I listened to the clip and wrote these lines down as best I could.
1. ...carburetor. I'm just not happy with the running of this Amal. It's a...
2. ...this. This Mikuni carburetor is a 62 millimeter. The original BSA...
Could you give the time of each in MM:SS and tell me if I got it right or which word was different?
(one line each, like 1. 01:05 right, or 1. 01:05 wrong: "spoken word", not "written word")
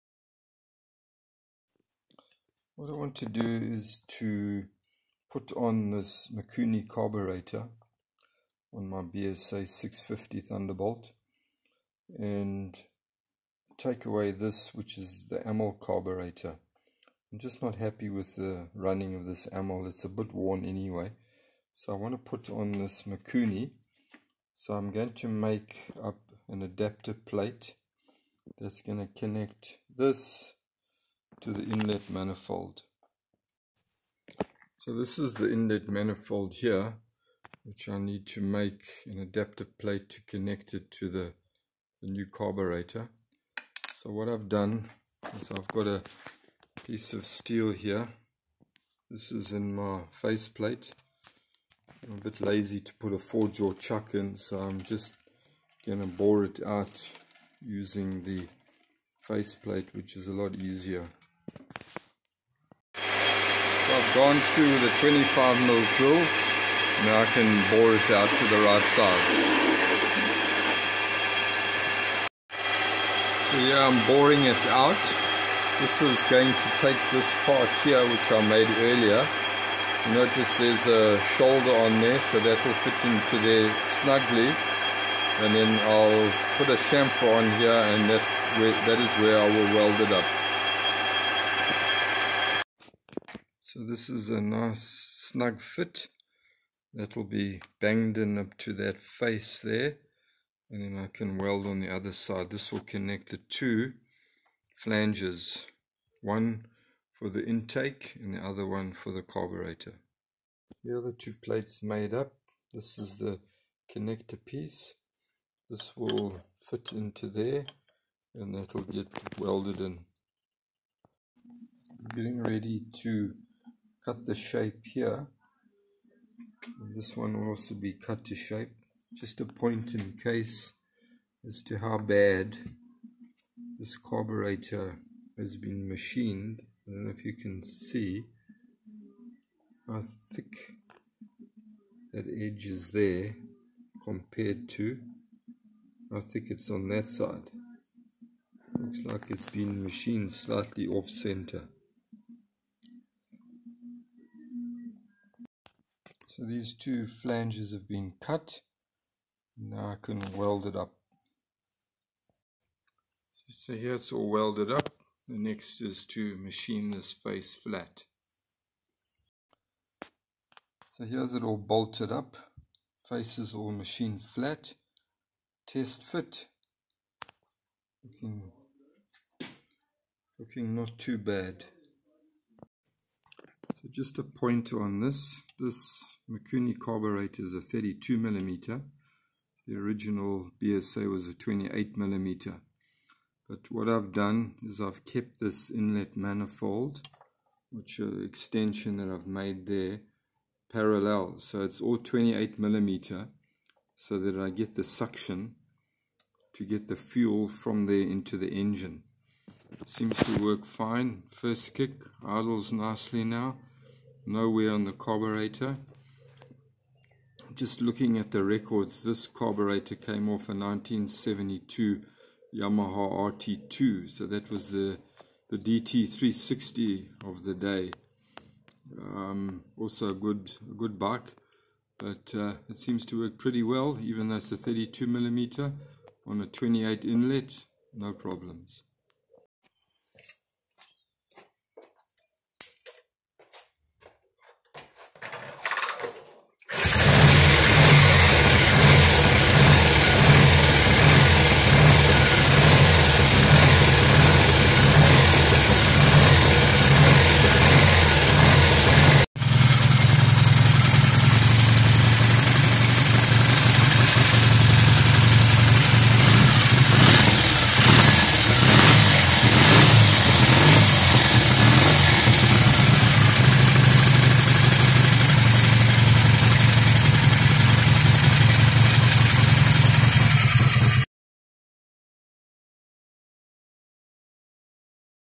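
1. 00:15 right
2. 03:05 wrong: "32", not "62".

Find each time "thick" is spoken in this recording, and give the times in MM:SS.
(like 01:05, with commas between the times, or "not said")
02:20, 02:26.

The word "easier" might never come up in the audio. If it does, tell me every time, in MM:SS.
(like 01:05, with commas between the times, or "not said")
01:00.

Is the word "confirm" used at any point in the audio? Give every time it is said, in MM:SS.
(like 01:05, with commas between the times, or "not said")
not said.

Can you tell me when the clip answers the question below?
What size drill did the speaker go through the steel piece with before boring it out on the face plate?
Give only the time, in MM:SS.
01:05.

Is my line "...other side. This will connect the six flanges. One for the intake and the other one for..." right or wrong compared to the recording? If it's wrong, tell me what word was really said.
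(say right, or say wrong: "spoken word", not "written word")
wrong: "two", not "six".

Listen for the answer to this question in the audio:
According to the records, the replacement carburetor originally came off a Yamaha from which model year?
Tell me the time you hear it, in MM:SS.
03:40.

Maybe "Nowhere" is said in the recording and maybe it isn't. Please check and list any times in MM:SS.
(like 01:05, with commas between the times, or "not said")
03:34.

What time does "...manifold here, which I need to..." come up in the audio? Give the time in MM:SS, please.
00:35.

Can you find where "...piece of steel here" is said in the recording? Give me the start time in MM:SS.
00:46.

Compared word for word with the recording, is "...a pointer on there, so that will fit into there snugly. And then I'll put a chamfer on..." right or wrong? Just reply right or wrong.
wrong.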